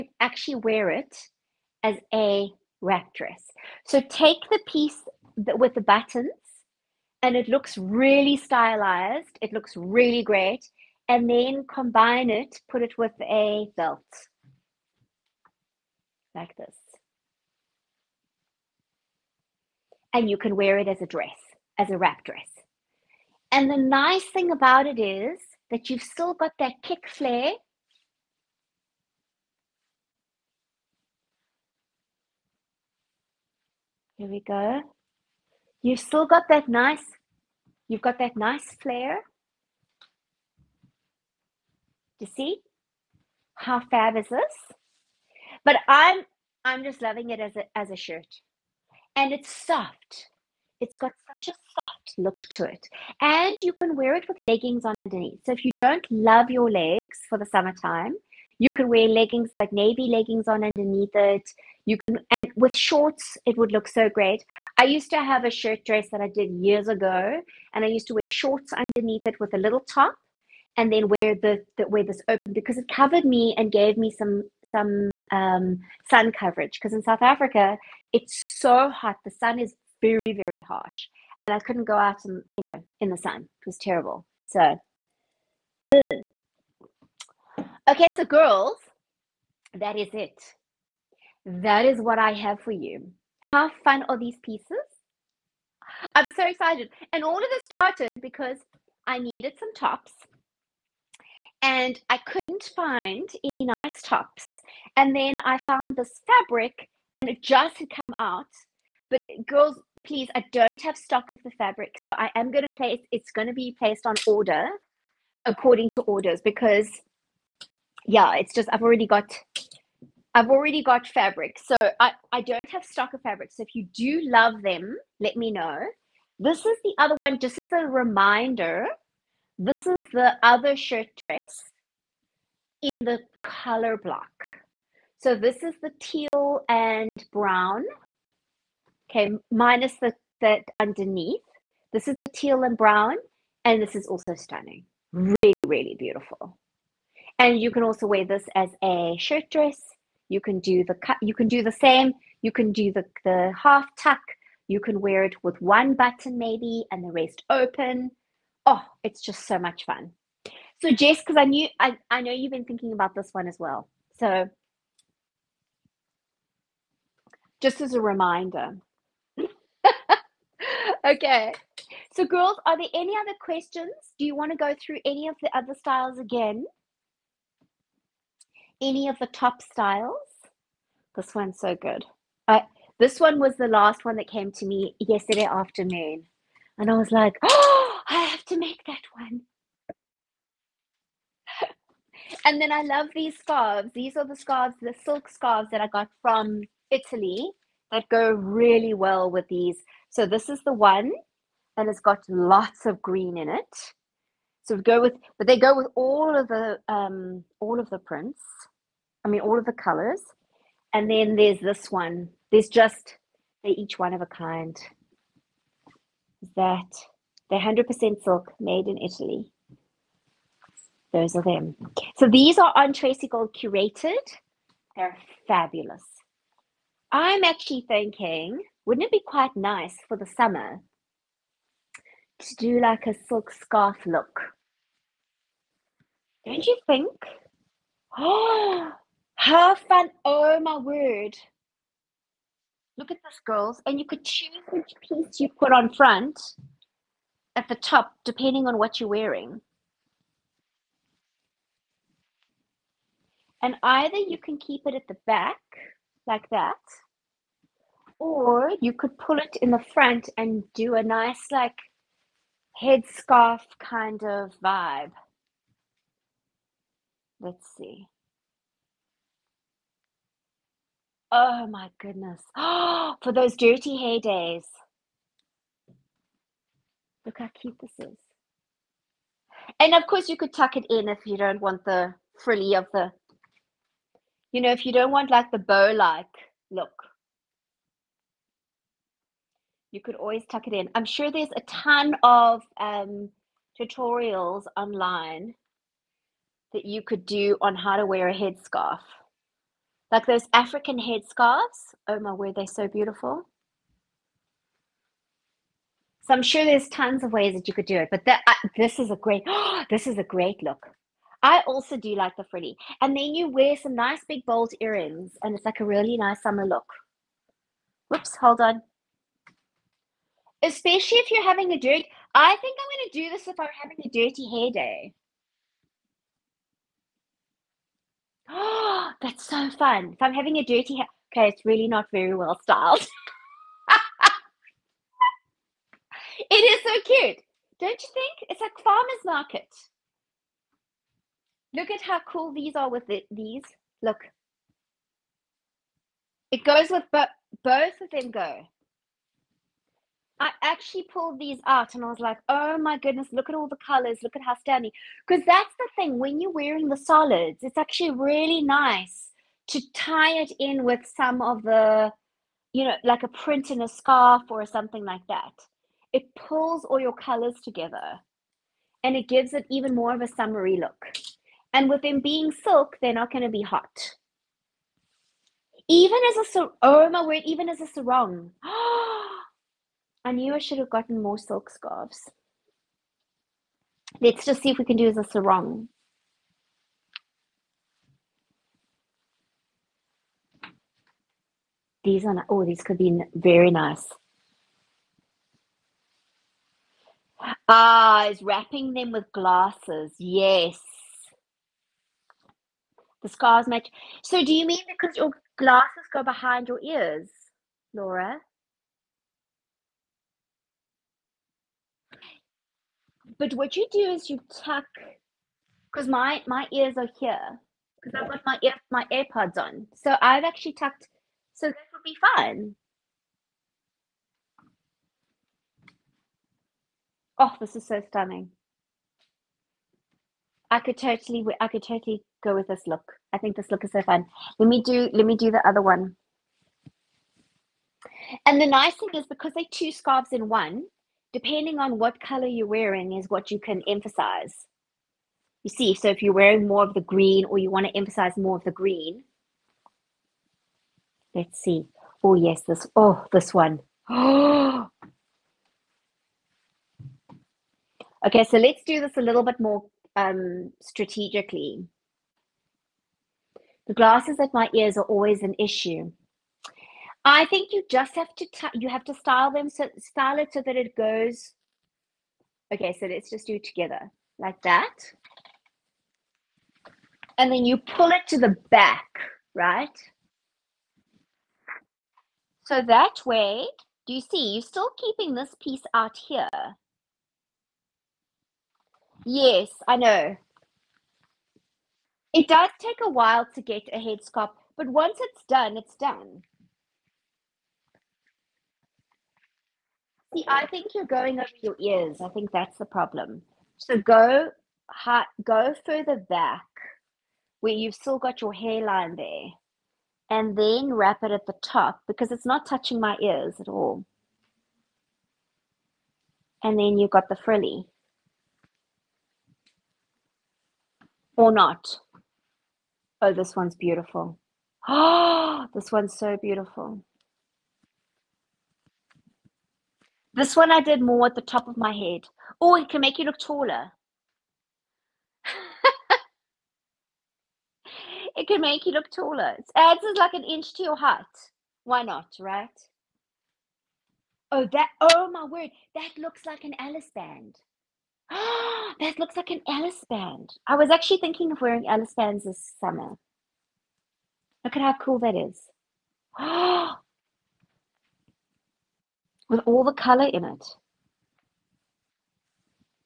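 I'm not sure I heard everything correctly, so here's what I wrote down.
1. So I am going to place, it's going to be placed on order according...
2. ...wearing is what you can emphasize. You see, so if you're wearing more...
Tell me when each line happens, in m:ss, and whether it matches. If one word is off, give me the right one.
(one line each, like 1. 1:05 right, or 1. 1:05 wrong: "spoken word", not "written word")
1. 1:52 right
2. 7:22 right.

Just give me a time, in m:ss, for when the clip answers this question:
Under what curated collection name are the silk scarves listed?
3:42.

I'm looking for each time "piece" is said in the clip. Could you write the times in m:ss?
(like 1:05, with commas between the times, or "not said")
0:04, 1:34, 4:05, 8:05.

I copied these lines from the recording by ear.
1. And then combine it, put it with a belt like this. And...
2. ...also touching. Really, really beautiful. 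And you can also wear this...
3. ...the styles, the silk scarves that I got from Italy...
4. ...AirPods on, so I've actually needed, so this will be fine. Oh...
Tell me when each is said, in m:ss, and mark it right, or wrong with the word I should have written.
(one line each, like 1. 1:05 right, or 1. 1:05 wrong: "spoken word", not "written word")
1. 0:11 right
2. 2:24 wrong: "stunning", not "touching"
3. 3:14 wrong: "scarves", not "styles"
4. 6:59 wrong: "tucked", not "needed".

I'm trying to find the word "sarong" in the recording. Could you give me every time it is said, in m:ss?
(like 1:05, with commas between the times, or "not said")
6:17, 6:25.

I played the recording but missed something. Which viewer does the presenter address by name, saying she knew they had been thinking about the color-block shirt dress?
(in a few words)
Jess.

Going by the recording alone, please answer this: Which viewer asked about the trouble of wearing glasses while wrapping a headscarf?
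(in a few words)
Laura.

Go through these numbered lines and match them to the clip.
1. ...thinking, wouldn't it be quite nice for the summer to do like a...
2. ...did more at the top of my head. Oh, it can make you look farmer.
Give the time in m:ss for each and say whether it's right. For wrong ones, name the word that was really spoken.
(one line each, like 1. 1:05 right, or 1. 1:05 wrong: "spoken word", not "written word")
1. 3:47 right
2. 8:50 wrong: "taller", not "farmer".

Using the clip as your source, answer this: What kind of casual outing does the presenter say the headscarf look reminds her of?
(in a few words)
farmer's market.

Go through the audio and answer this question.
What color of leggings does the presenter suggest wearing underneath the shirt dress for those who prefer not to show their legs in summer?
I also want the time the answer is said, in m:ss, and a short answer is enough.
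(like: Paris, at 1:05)
navy, at 0:59.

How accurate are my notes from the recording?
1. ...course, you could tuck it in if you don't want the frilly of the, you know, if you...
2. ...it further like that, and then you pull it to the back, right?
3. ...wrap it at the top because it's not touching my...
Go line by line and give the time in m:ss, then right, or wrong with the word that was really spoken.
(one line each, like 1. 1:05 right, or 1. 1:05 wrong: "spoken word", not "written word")
1. 4:40 right
2. 7:53 wrong: "together", not "further"
3. 8:30 right.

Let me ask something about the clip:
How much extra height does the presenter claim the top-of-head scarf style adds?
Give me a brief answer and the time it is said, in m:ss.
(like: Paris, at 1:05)
an inch, at 9:00.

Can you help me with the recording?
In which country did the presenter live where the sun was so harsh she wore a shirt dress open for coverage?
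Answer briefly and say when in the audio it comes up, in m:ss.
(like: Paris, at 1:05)
South Africa, at 1:17.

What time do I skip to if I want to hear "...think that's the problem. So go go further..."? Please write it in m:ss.
8:22.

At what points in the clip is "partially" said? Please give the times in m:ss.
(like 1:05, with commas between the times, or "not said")
not said.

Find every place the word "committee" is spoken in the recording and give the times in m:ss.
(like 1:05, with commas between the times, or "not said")
not said.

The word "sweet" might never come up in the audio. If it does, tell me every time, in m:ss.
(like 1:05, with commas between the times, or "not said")
not said.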